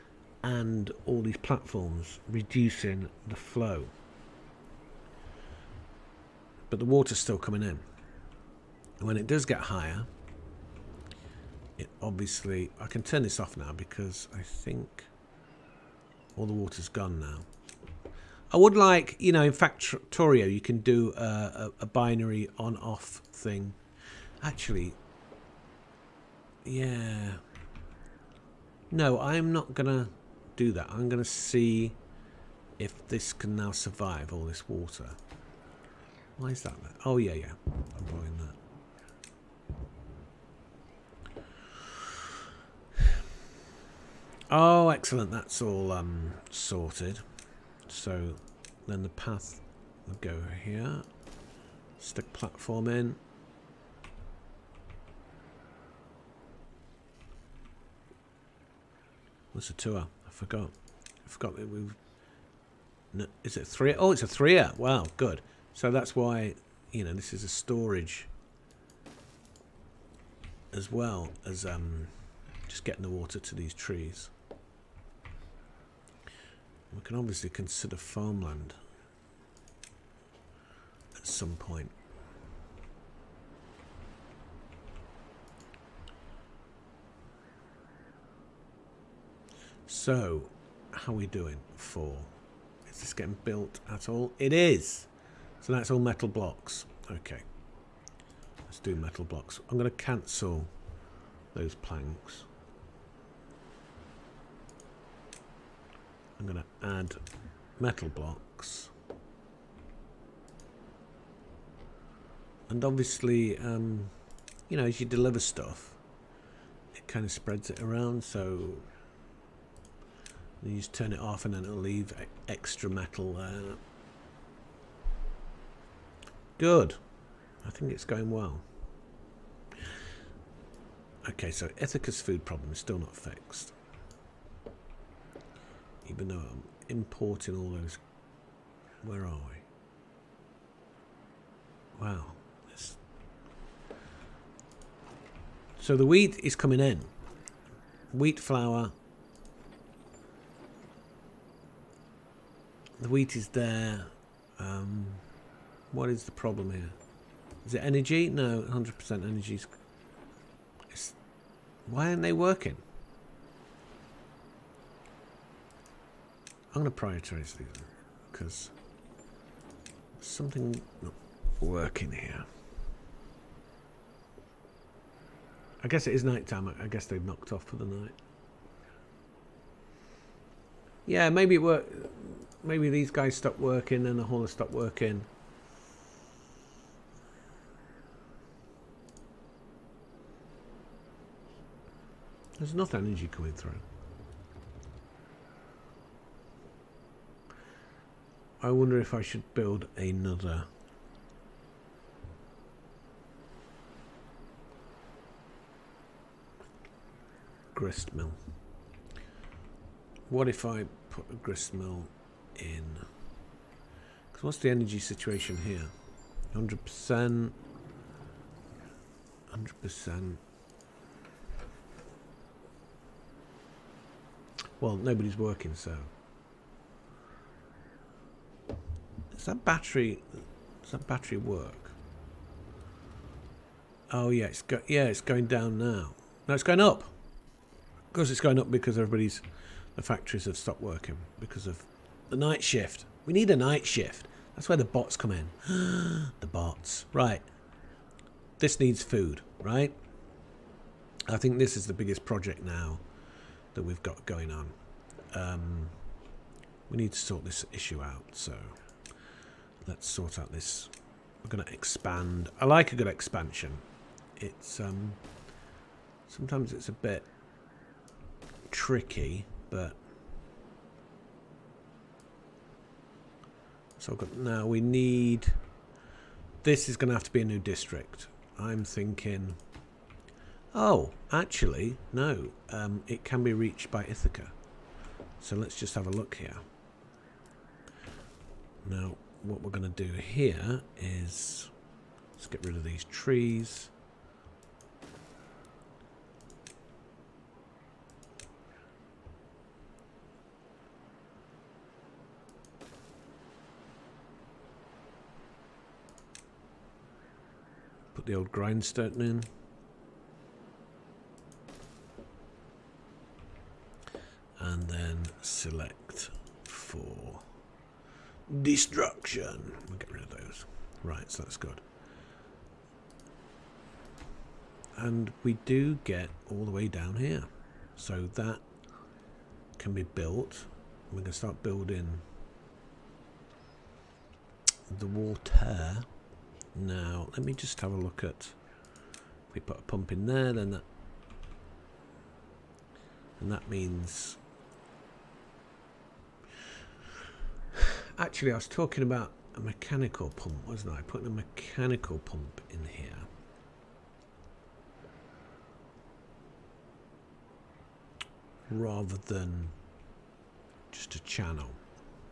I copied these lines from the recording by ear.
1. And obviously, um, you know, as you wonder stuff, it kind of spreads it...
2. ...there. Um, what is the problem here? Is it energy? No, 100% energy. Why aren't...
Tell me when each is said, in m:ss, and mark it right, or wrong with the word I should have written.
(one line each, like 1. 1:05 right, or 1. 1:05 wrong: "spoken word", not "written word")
1. 1:52 wrong: "deliver", not "wonder"
2. 2:33 right.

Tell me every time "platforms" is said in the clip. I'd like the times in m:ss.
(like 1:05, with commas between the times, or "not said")
0:01, 0:52.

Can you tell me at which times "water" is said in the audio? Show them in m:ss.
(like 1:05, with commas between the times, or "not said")
0:06, 0:16, 0:34, 1:13, 5:35.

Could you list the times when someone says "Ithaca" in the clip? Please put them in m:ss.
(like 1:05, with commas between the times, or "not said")
2:11, 4:44.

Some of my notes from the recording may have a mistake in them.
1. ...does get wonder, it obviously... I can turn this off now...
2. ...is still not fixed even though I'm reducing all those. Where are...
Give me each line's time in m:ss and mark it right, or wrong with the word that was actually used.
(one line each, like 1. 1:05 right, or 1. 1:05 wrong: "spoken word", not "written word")
1. 0:09 wrong: "higher", not "wonder"
2. 2:12 wrong: "importing", not "reducing".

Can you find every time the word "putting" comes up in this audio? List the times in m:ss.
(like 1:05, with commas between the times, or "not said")
5:51.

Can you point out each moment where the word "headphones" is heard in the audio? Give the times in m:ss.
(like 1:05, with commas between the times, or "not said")
not said.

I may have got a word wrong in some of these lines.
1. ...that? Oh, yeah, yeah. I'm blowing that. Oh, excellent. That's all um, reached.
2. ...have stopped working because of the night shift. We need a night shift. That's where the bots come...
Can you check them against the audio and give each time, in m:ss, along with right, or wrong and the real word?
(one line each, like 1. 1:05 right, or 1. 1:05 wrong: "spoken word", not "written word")
1. 0:36 wrong: "sorted", not "reached"
2. 4:00 right.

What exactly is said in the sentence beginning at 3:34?
Because what's the energy situation here?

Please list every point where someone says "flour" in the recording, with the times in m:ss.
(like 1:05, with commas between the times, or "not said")
2:28.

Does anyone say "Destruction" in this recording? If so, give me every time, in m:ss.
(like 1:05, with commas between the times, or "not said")
5:18.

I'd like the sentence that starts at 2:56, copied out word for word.
I guess they've knocked off for the night.